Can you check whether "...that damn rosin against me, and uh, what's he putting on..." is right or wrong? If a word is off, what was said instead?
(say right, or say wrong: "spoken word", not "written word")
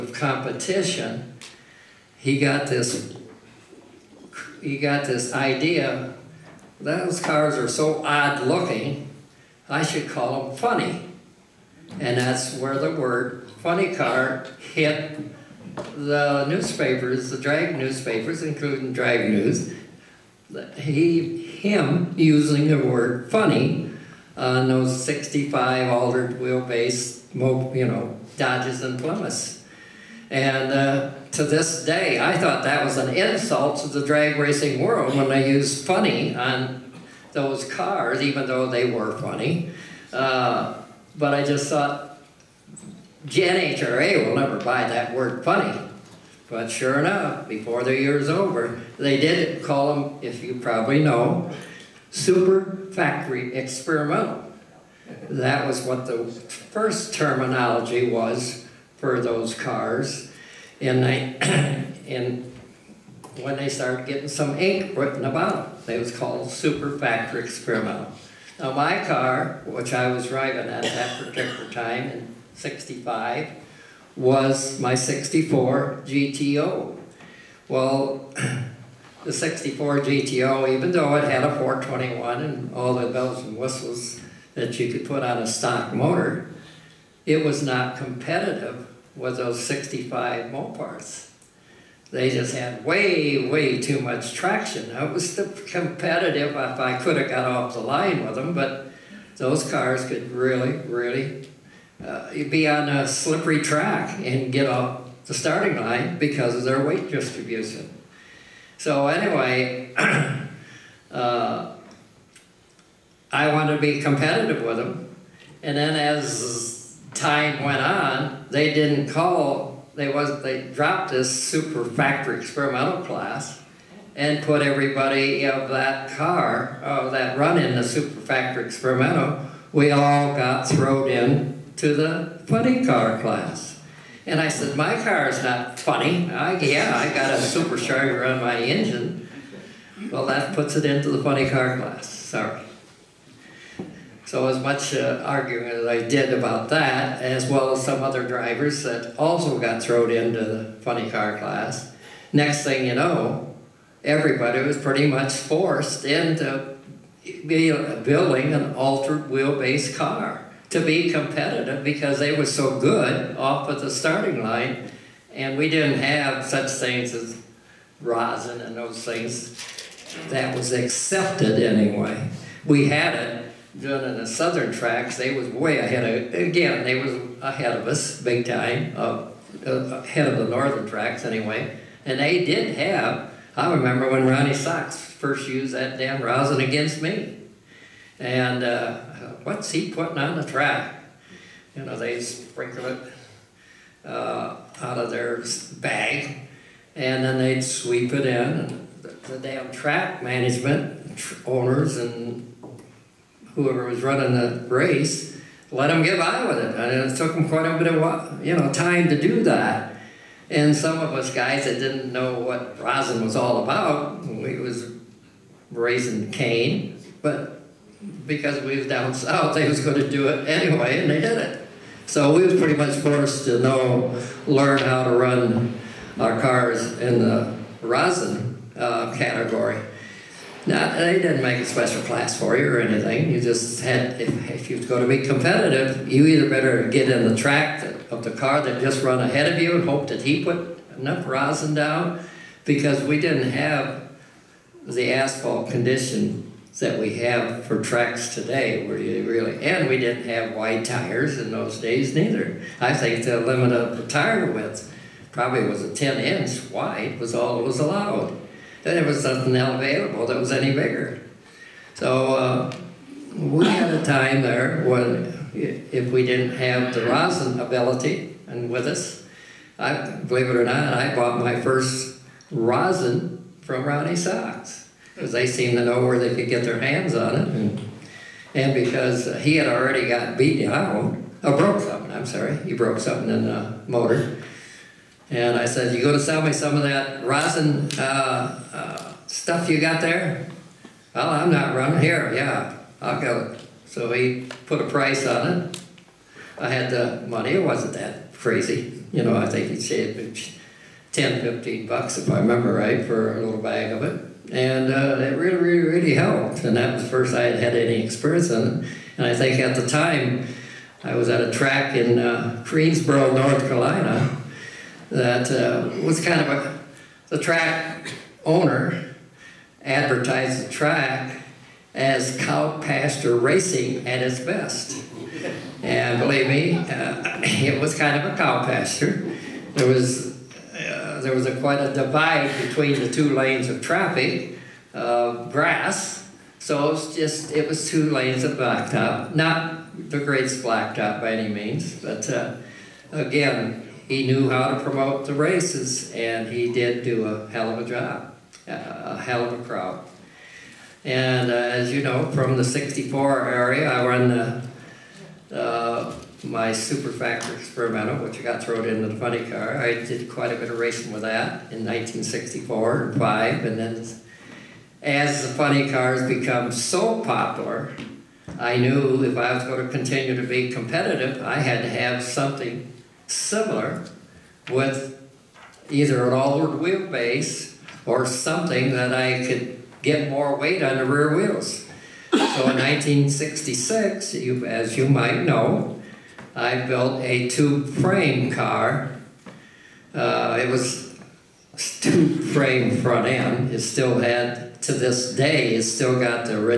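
right.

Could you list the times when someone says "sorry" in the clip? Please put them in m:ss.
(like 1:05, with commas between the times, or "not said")
2:22, 4:42.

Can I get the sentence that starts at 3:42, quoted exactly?
So we was pretty much forced to know, learn how to run our cars in the rosin uh, category.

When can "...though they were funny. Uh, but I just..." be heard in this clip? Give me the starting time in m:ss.
0:38.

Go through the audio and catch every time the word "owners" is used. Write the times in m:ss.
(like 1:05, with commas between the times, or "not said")
3:21, 5:18.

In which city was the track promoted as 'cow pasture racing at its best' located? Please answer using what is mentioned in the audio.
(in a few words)
Greensboro, North Carolina.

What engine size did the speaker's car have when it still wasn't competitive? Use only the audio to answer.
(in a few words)
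421.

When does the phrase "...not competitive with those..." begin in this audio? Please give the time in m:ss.
1:27.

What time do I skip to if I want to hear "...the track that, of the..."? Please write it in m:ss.
3:57.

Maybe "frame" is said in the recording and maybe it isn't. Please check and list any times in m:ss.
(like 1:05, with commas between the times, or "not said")
6:27, 6:32.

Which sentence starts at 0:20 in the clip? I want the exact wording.
He, him using the word funny on those 65 altered wheelbase, you know, Dodges and Plymouths.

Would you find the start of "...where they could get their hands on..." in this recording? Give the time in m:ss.
4:36.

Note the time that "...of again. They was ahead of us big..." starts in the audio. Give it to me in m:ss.
2:56.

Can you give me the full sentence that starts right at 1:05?
It was called Super Factor experimental.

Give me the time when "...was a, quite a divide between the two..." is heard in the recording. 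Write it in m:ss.
5:31.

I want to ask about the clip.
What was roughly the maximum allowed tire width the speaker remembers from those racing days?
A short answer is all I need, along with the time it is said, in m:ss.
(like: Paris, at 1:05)
10 inch, at 4:15.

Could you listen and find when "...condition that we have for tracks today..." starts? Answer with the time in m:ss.
4:05.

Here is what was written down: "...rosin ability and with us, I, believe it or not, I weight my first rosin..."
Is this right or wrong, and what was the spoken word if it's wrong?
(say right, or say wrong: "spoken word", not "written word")
wrong: "bought", not "weight".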